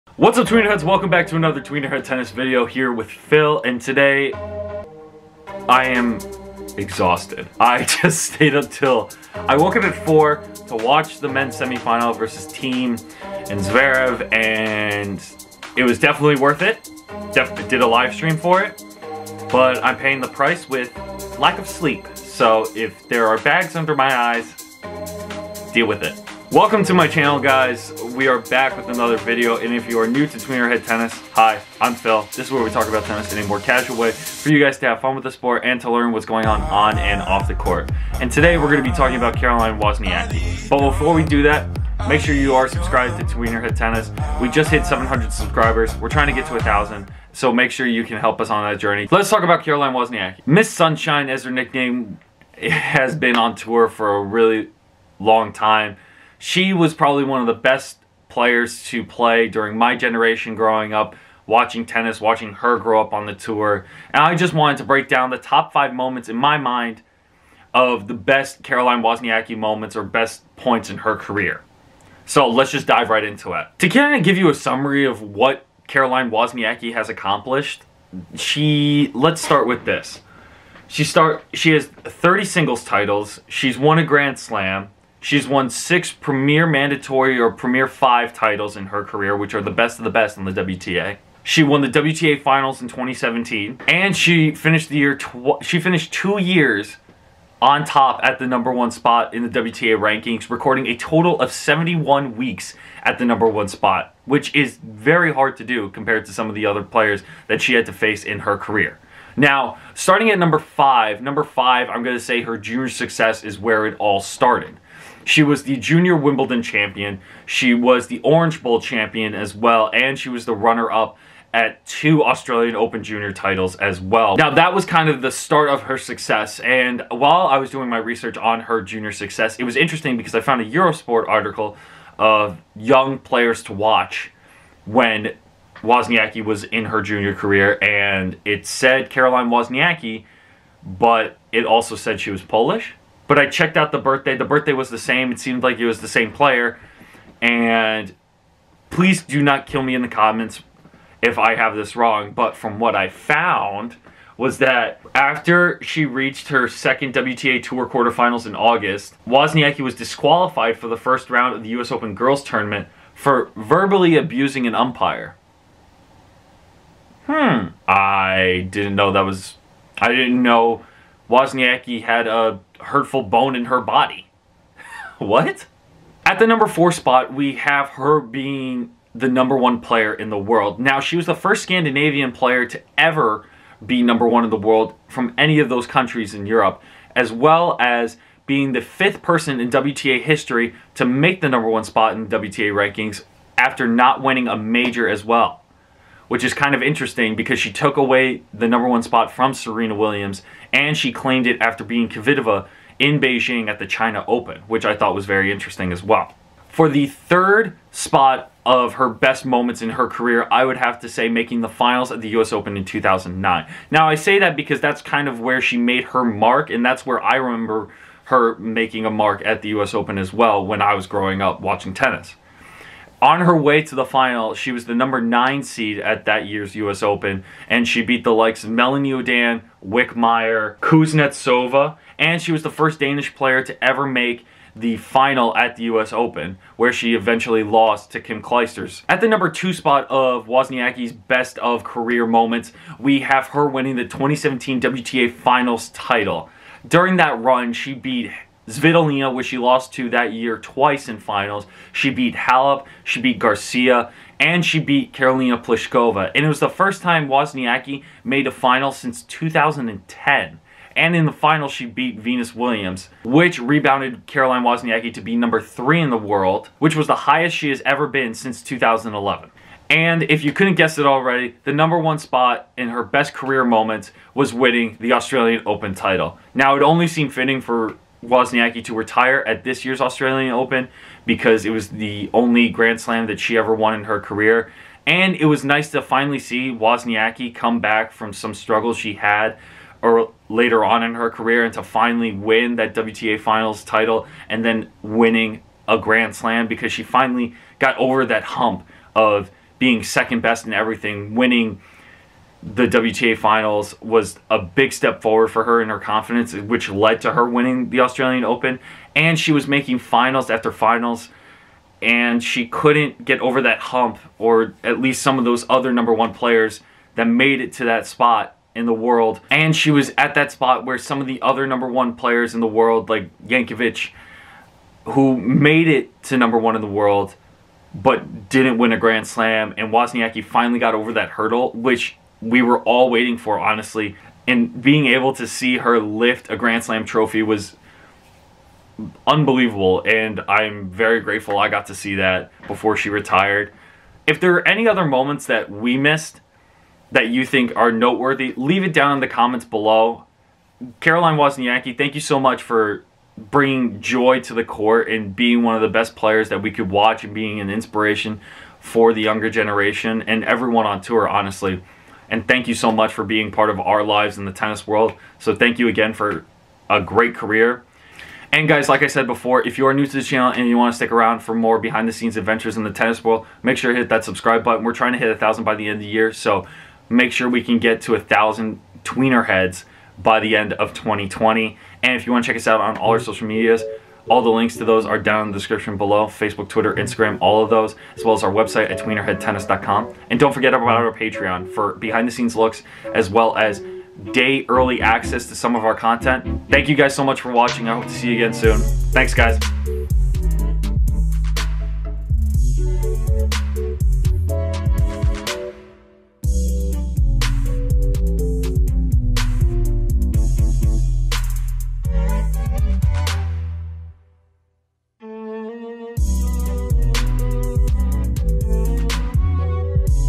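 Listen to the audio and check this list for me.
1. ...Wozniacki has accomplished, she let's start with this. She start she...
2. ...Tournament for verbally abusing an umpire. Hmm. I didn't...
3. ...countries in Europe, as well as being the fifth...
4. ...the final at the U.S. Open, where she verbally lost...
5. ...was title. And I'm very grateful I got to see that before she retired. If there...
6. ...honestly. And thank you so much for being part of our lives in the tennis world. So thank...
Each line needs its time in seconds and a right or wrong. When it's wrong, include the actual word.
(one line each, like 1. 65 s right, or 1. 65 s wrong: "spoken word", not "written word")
1. 76 s right
2. 162 s right
3. 185 s right
4. 234 s wrong: "eventually", not "verbally"
5. 337 s wrong: "unbelievable", not "title"
6. 361 s right.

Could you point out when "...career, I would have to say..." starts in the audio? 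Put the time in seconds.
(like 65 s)
210 s.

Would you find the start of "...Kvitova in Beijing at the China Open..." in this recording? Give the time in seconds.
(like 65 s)
202 s.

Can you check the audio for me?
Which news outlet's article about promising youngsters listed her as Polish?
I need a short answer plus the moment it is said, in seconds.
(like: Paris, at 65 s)
Eurosport, at 130 s.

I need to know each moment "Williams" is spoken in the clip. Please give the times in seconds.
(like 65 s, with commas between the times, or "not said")
199 s, 262 s.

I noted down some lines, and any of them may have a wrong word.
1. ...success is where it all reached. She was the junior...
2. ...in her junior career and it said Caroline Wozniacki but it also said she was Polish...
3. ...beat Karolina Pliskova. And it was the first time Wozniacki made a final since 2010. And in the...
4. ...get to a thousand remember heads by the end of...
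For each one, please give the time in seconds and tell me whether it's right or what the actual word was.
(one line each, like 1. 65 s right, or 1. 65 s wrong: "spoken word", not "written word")
1. 112 s wrong: "started", not "reached"
2. 136 s right
3. 254 s right
4. 377 s wrong: "tweener", not "remember".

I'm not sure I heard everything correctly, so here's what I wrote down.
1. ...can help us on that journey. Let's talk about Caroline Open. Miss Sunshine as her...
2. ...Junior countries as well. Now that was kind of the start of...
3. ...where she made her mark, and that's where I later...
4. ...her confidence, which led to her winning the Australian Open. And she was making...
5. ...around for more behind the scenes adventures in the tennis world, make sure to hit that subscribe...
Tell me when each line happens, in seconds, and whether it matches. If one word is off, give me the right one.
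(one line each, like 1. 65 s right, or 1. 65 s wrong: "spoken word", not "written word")
1. 48 s wrong: "Wozniacki", not "Open"
2. 123 s wrong: "titles", not "countries"
3. 215 s wrong: "remember", not "later"
4. 305 s right
5. 371 s right.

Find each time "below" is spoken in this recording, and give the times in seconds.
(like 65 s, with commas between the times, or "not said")
349 s, 385 s.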